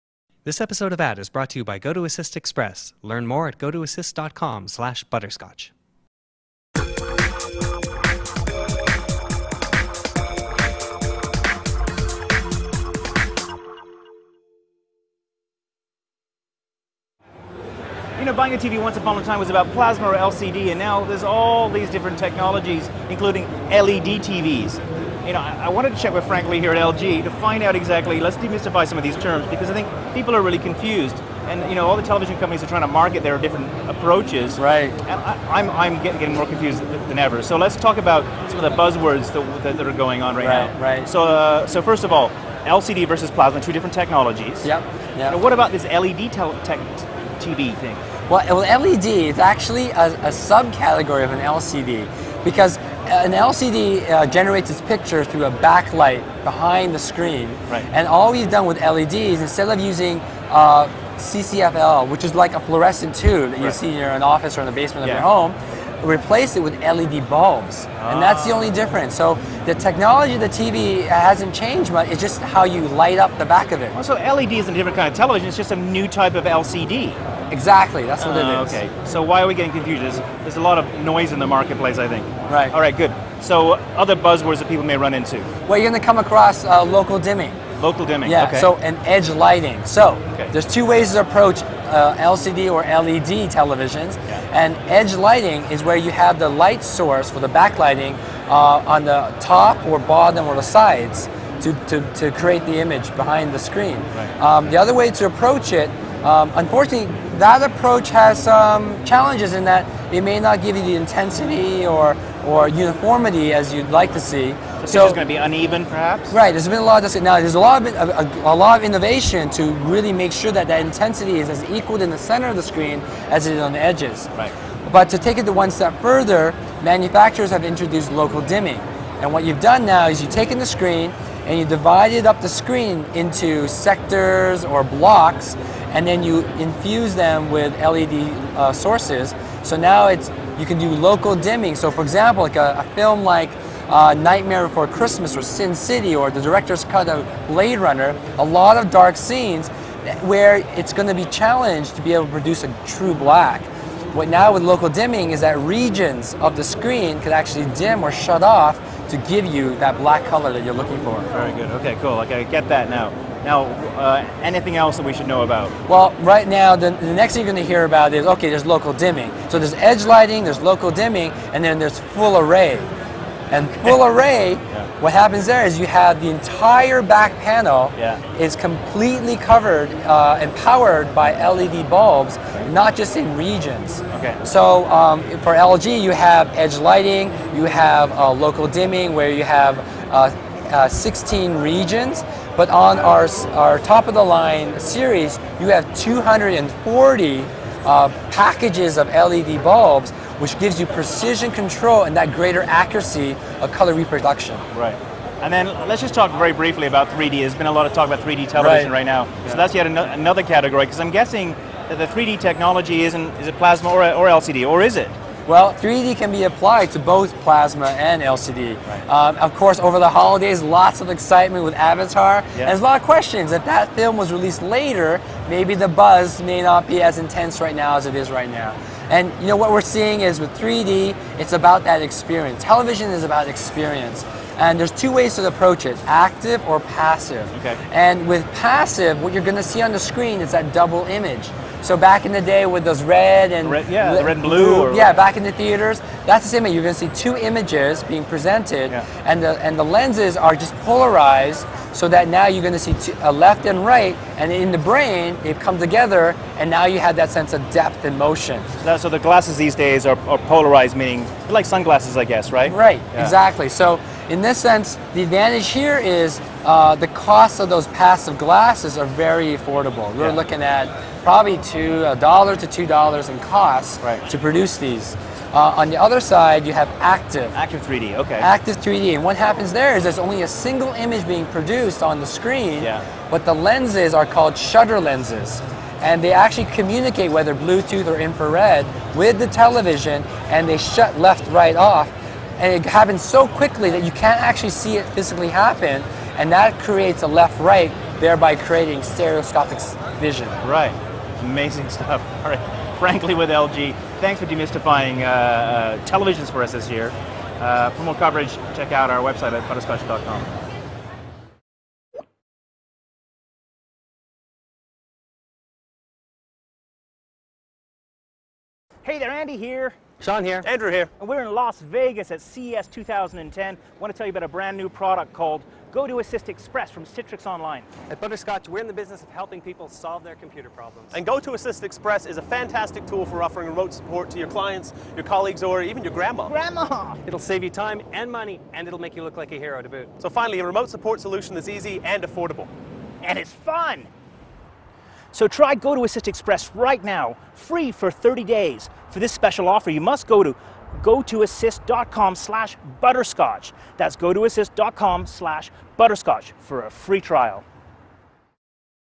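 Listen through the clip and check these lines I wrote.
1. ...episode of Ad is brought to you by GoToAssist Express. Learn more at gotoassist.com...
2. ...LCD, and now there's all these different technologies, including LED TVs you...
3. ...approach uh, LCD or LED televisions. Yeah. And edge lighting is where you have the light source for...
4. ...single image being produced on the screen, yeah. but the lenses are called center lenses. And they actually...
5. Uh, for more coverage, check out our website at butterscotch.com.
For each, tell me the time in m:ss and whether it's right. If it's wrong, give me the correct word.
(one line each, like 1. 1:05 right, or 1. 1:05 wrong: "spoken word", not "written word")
1. 0:00 right
2. 0:20 right
3. 1:31 right
4. 4:40 wrong: "shutter", not "center"
5. 5:07 right.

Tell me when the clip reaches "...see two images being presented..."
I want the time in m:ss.
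4:06.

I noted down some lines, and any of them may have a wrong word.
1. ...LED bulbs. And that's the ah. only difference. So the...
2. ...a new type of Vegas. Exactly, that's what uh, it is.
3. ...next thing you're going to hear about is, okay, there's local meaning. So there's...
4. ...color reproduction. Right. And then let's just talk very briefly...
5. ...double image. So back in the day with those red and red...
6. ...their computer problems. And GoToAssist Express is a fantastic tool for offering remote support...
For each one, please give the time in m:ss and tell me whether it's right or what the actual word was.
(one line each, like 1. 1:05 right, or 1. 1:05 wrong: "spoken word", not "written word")
1. 1:06 right
2. 1:15 wrong: "LCD", not "Vegas"
3. 2:47 wrong: "dimming", not "meaning"
4. 3:23 right
5. 4:00 right
6. 5:30 right.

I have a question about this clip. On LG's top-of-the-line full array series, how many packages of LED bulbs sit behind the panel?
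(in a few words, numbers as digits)
240.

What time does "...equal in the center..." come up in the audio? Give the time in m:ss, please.
2:01.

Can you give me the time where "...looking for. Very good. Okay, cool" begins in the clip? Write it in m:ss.
2:40.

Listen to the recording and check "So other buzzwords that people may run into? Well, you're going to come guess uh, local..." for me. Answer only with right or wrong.
wrong.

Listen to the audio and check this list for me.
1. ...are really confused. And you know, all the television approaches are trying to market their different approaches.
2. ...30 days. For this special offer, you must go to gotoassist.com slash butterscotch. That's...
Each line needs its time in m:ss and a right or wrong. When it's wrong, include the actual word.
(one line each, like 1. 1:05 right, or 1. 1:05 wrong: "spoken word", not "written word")
1. 0:30 wrong: "companies", not "approaches"
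2. 5:48 right.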